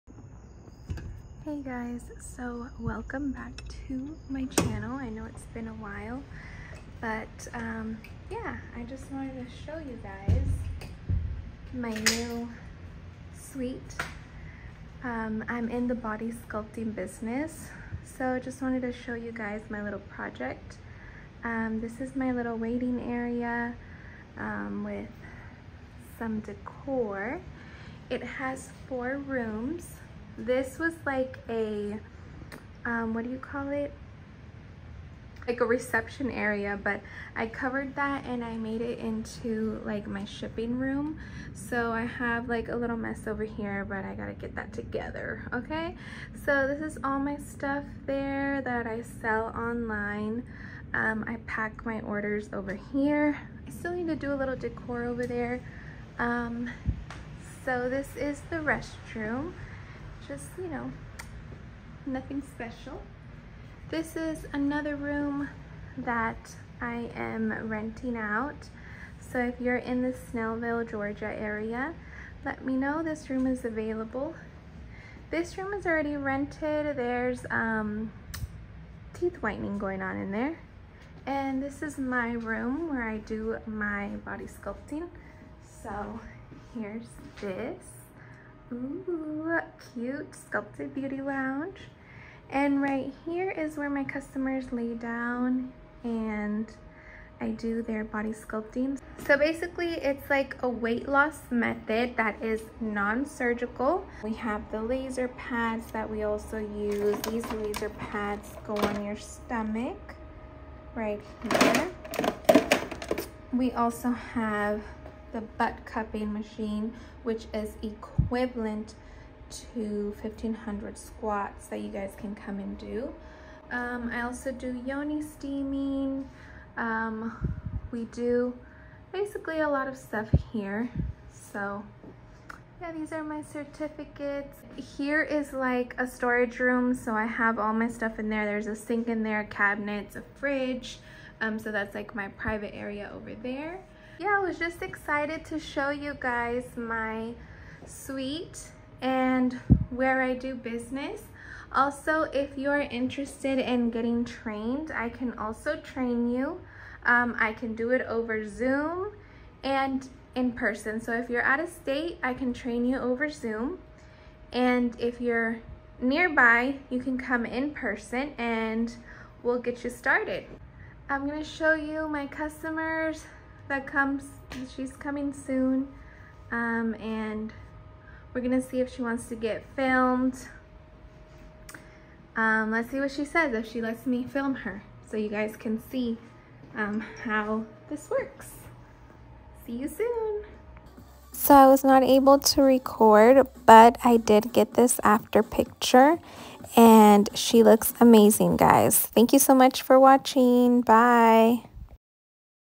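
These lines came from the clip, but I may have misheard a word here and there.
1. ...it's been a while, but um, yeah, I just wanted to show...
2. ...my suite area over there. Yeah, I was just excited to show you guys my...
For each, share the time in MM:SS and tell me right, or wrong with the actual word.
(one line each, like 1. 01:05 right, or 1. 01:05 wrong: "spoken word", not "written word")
1. 00:05 right
2. 02:22 wrong: "private", not "suite".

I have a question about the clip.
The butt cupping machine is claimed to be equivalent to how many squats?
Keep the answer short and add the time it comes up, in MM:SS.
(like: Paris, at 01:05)
1500, at 02:00.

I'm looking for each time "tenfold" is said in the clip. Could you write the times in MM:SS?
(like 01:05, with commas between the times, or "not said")
not said.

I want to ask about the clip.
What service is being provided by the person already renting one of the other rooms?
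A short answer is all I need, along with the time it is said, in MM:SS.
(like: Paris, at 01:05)
Teeth whitening, at 01:19.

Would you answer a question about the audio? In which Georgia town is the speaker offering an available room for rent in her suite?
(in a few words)
Snellville.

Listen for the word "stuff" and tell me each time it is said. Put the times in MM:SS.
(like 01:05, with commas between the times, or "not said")
00:47, 02:09, 02:17.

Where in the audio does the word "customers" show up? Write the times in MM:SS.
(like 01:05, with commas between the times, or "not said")
01:34, 02:52.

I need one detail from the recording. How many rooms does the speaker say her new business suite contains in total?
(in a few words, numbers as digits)
4.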